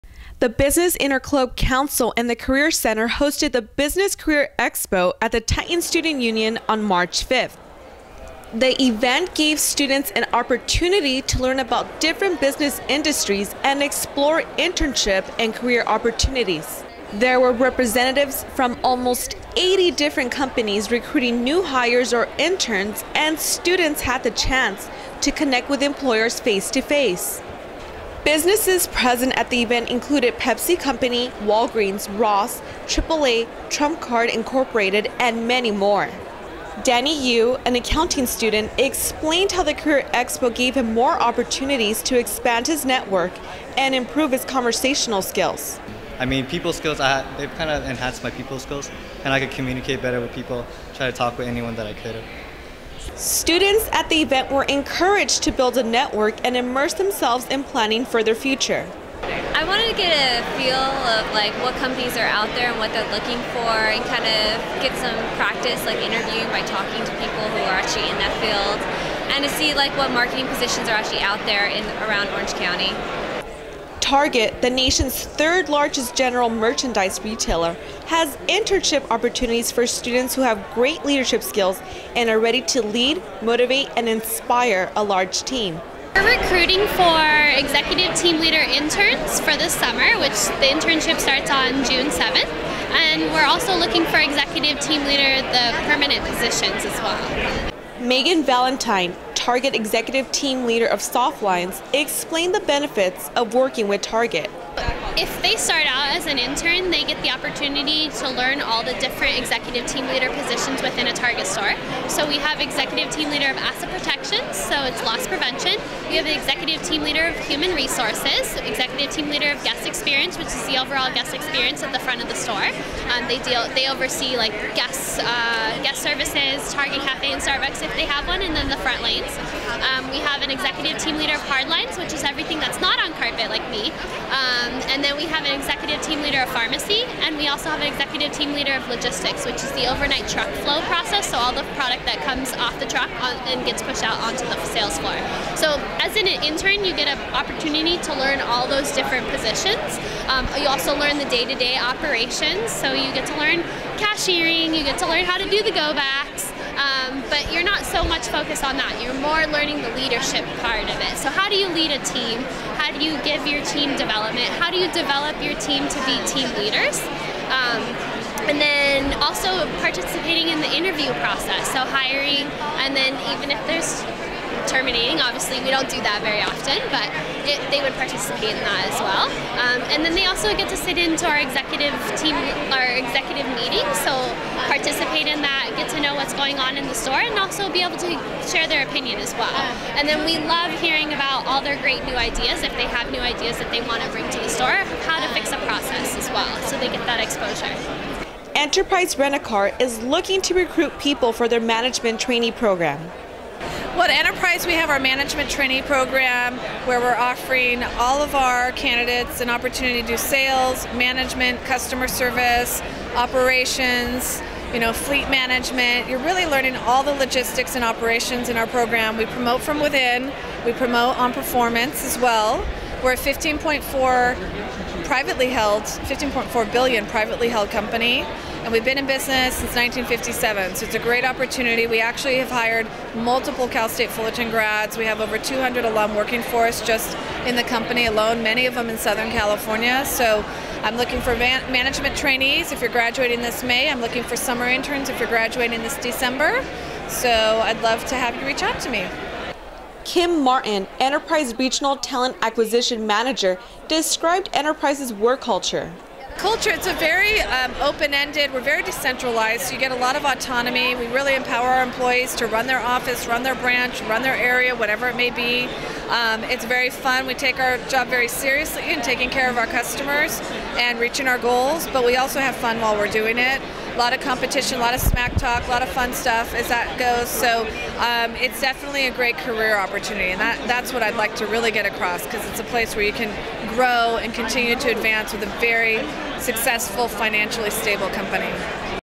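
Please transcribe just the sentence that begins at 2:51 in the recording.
So hiring, and then even if there's terminating.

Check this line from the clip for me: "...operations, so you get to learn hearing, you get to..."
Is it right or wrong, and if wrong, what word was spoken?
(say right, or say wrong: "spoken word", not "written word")
wrong: "cashiering", not "hearing".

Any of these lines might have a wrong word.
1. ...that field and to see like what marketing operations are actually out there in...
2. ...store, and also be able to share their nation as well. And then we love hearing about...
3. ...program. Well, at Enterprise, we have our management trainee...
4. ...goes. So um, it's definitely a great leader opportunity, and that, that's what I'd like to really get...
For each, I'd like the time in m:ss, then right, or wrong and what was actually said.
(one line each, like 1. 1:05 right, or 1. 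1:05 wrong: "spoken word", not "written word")
1. 1:08 wrong: "positions", not "operations"
2. 3:06 wrong: "opinion", not "nation"
3. 3:22 right
4. 4:36 wrong: "career", not "leader".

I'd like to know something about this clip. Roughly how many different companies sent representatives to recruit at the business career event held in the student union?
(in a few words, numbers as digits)
80.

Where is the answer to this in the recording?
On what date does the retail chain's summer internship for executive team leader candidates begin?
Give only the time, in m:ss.
1:31.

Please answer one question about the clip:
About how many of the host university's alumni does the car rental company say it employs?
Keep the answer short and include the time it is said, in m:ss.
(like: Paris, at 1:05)
Over 200, at 3:55.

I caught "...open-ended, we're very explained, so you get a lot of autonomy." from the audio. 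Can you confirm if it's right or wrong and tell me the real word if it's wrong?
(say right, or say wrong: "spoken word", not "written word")
wrong: "decentralized", not "explained".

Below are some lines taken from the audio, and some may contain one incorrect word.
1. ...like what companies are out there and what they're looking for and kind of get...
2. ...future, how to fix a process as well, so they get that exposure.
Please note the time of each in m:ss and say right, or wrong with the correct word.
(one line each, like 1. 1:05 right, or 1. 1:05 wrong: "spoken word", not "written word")
1. 1:01 right
2. 3:14 wrong: "store", not "future".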